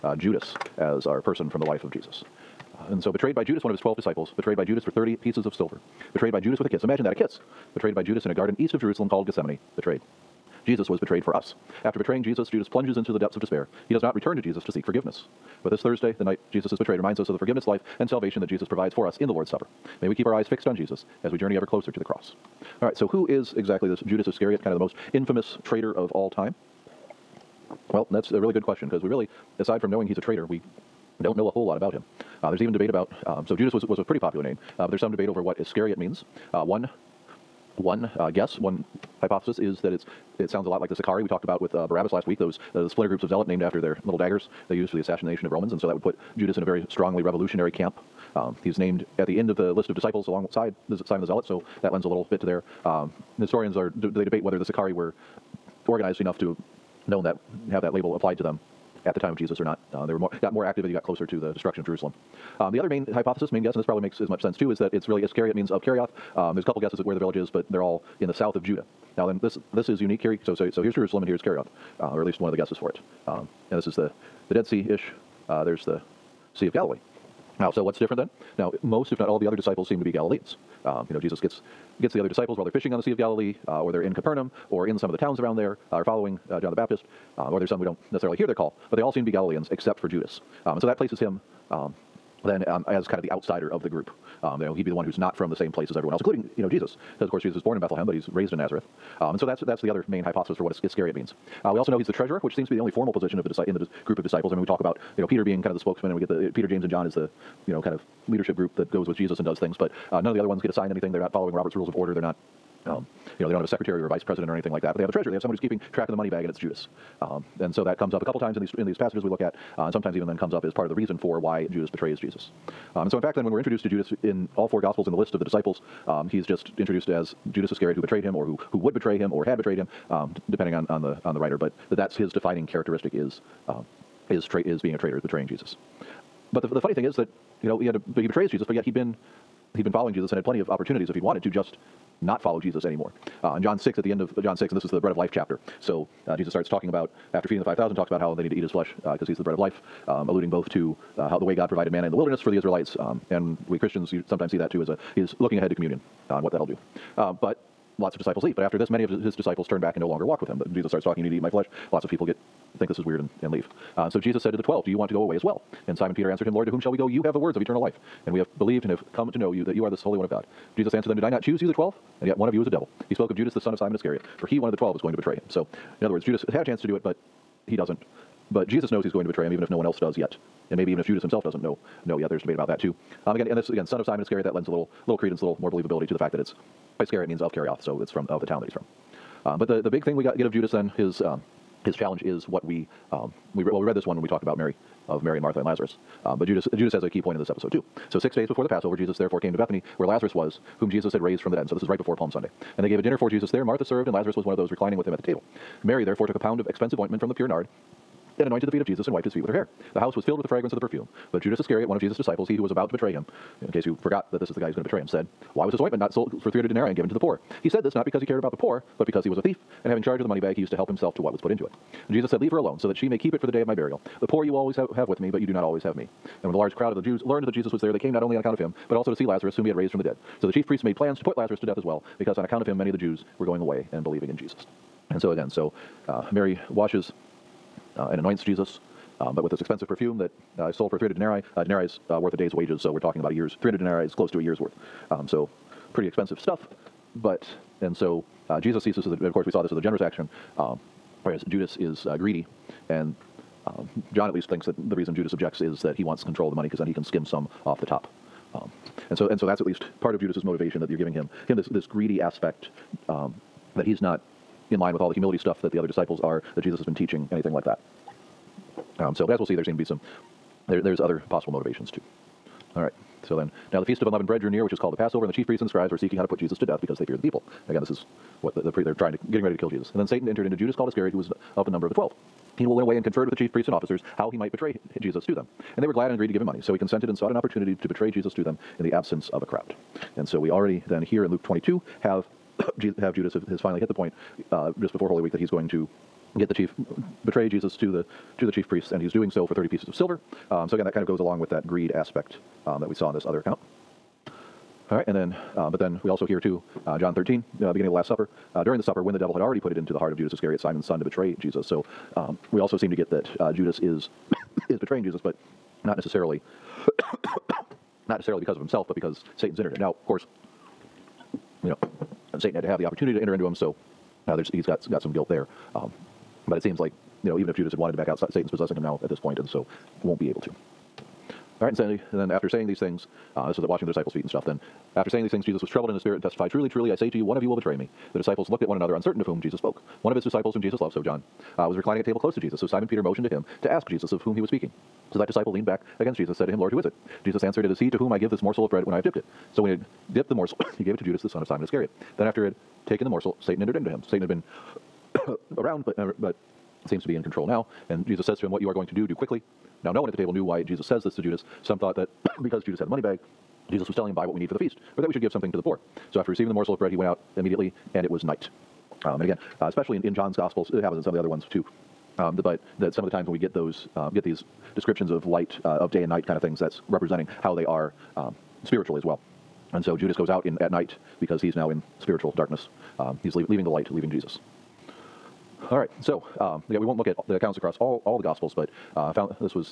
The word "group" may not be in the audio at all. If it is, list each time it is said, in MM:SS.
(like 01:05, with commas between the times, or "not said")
00:43, 01:33, 01:44, 01:48.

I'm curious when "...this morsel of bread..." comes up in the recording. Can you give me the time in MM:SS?
05:48.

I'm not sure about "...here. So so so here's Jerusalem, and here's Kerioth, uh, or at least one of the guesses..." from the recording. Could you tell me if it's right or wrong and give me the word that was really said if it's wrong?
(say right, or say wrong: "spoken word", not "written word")
right.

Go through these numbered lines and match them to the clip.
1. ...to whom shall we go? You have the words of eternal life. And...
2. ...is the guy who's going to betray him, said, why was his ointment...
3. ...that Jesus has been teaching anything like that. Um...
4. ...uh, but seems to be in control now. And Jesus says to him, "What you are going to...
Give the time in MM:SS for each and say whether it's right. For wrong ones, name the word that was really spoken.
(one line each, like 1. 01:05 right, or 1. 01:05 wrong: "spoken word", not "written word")
1. 02:46 right
2. 03:34 right
3. 04:26 right
4. 05:55 right.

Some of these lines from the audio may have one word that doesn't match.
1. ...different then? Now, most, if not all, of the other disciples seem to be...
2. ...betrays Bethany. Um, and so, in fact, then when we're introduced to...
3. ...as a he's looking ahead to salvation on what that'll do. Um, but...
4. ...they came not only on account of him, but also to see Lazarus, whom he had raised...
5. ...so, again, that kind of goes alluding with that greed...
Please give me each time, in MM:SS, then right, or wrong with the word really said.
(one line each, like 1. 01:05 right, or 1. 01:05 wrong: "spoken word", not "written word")
1. 01:17 right
2. 02:01 wrong: "Jesus", not "Bethany"
3. 02:34 wrong: "communion", not "salvation"
4. 03:47 right
5. 05:00 wrong: "along", not "alluding".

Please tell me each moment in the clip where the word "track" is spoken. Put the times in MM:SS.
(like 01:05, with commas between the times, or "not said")
01:55.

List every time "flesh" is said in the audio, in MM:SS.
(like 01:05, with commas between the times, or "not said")
02:28, 02:41.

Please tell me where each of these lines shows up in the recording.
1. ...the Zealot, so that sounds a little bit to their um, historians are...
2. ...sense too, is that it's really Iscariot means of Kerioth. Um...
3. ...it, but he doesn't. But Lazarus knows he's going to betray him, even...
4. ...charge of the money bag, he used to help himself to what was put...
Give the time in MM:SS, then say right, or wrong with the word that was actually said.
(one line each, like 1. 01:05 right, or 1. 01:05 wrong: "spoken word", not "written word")
1. 00:51 wrong: "lends", not "sounds"
2. 01:04 right
3. 02:56 wrong: "Jesus", not "Lazarus"
4. 03:40 right.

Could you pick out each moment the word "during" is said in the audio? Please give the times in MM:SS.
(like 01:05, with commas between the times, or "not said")
05:08.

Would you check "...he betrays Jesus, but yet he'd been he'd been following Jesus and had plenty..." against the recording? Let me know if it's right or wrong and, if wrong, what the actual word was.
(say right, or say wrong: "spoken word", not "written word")
right.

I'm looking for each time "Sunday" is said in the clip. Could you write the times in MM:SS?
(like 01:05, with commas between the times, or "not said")
03:22.